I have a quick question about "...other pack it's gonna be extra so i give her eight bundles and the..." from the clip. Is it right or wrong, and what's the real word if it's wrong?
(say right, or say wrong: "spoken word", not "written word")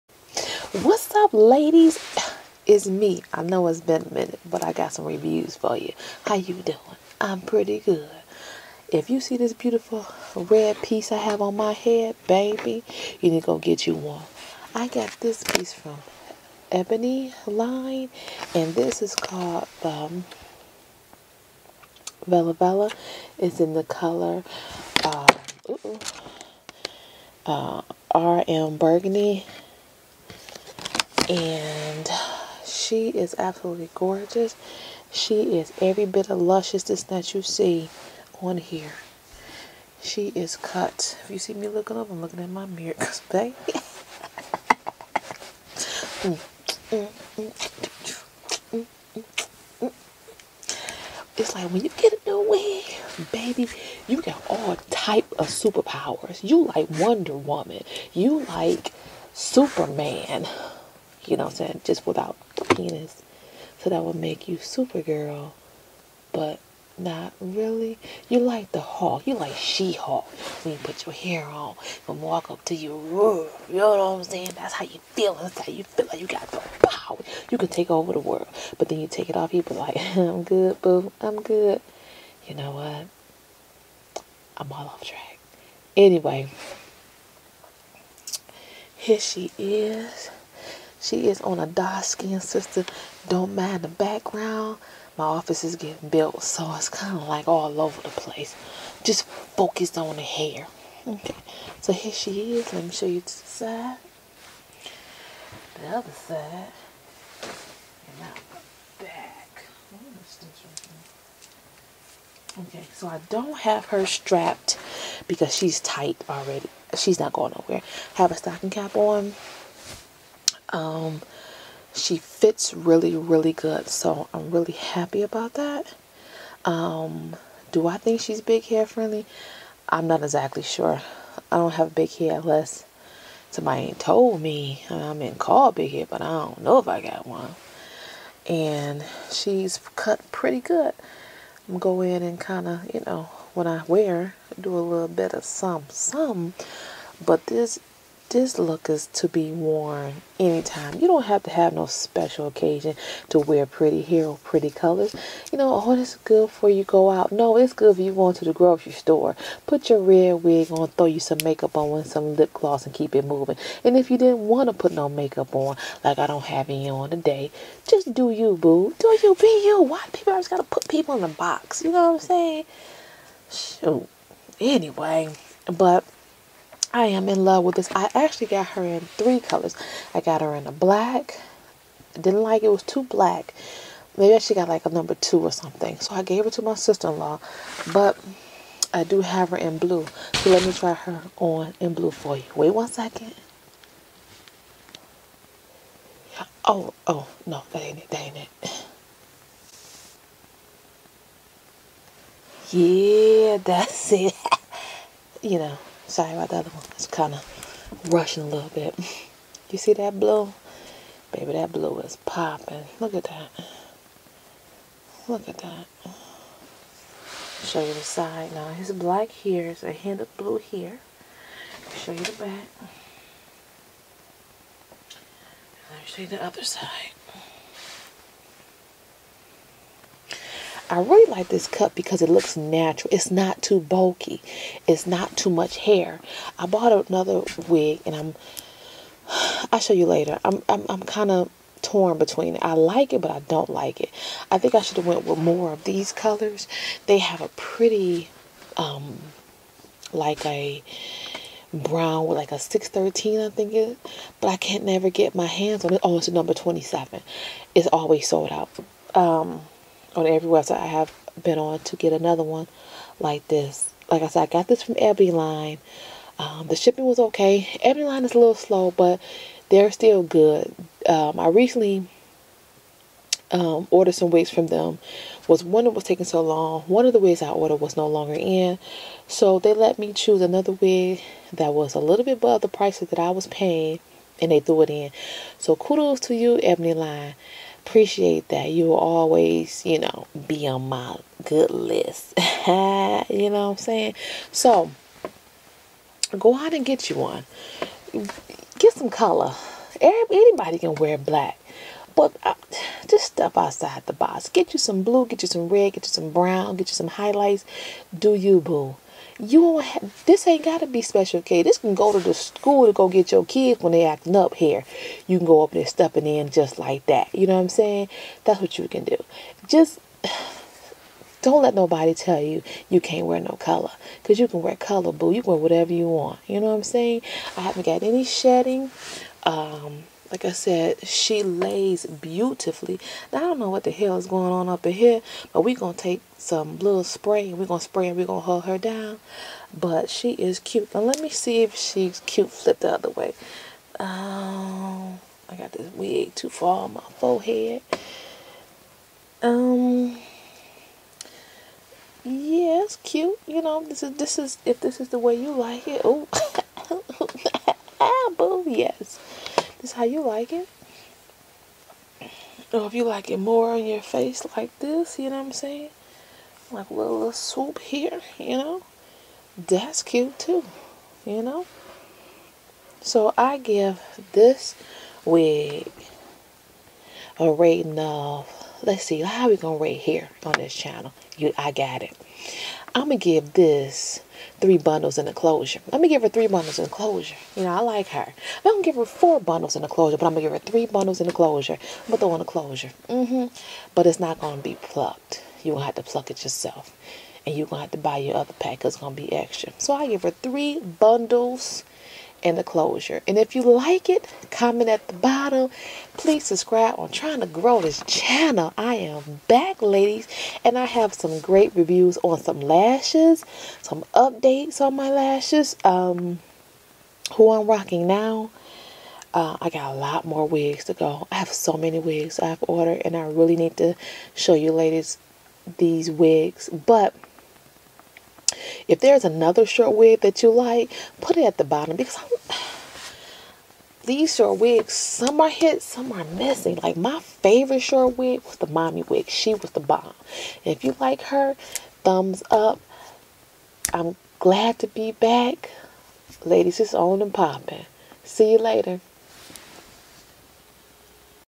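wrong: "three", not "eight".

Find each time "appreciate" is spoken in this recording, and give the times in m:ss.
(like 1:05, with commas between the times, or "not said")
4:47.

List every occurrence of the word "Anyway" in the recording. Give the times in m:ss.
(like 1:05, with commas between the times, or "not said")
1:25, 2:54.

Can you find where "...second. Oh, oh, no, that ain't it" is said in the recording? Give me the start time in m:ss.
3:12.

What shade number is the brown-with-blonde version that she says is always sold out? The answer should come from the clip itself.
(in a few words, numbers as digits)
27.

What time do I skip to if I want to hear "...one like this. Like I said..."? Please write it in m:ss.
4:22.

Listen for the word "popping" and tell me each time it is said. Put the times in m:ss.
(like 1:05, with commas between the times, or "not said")
3:32, 7:27.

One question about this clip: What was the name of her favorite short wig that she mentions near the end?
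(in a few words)
The mommy wig.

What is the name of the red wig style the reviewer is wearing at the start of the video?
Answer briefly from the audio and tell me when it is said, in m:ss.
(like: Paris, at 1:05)
Vella Vella, at 0:22.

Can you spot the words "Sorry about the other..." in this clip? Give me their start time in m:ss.
3:26.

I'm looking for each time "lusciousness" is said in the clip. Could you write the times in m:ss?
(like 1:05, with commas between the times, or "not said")
0:36.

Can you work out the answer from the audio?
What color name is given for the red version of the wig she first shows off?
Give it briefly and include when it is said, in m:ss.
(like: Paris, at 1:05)
RM Burgundy, at 0:28.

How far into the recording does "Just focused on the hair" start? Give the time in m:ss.
1:39.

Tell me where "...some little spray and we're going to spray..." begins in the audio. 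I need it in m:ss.
5:36.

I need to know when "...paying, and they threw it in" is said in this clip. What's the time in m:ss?
4:43.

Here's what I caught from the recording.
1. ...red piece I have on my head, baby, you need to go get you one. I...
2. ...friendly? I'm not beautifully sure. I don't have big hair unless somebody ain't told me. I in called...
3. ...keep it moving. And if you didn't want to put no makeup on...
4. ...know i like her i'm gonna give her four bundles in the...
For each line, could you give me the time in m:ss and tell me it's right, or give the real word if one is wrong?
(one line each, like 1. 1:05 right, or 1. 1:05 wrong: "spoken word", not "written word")
1. 0:10 right
2. 2:08 wrong: "exactly", not "beautifully"
3. 2:42 right
4. 6:27 right.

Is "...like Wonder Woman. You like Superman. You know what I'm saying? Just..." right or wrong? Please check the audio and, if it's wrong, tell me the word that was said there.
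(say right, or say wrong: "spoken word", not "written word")
right.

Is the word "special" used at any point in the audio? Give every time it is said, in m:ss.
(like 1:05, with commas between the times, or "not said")
2:31, 5:11.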